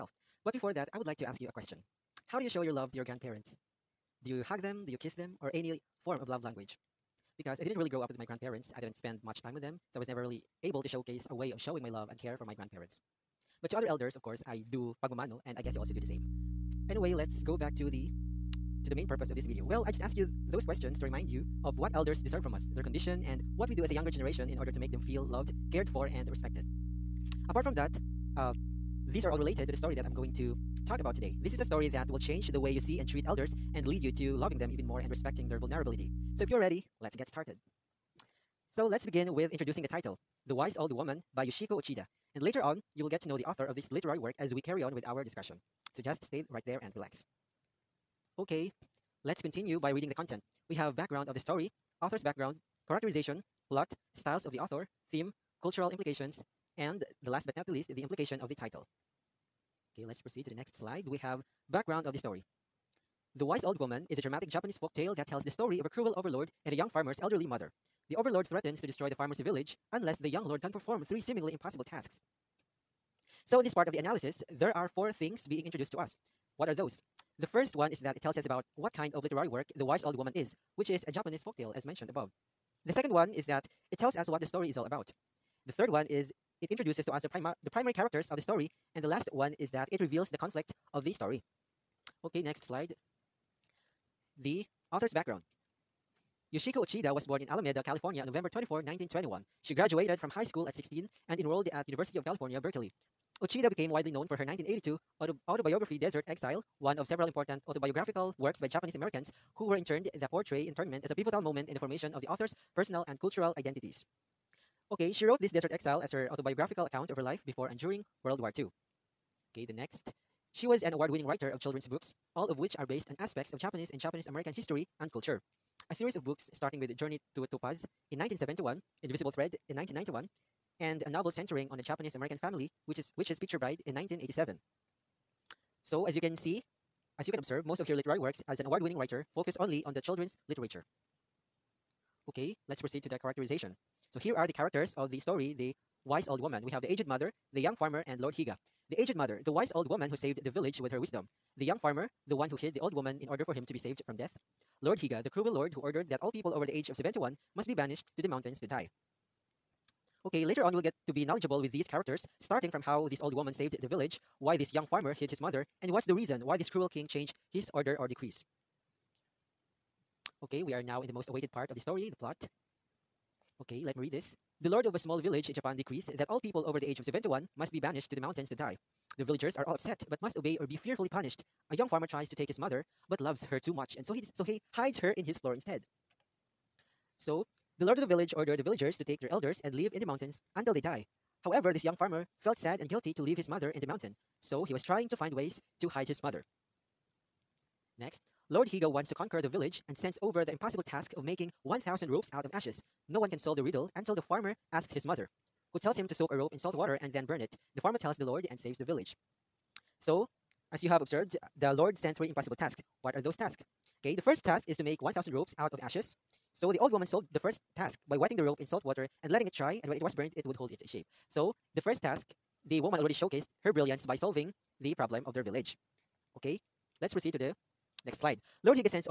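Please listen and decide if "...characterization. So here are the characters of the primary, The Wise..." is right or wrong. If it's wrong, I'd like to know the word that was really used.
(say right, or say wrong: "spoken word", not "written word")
wrong: "story", not "primary".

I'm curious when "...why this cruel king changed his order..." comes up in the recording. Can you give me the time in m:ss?
2:46.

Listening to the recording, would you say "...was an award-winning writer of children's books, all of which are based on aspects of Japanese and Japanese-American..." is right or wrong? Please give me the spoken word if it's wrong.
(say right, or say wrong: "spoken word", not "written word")
right.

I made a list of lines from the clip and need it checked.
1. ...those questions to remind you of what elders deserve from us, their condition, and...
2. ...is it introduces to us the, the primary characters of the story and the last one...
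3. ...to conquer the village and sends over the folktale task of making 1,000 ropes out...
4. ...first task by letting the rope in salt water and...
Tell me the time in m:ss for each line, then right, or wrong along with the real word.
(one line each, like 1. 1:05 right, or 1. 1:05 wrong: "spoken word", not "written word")
1. 0:20 right
2. 1:26 right
3. 3:19 wrong: "impossible", not "folktale"
4. 3:37 wrong: "wetting", not "letting".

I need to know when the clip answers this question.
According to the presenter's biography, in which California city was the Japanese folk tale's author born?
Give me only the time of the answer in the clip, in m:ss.
1:37.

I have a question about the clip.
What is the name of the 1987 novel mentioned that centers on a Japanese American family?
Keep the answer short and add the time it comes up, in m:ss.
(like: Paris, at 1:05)
Picture Bride, at 2:13.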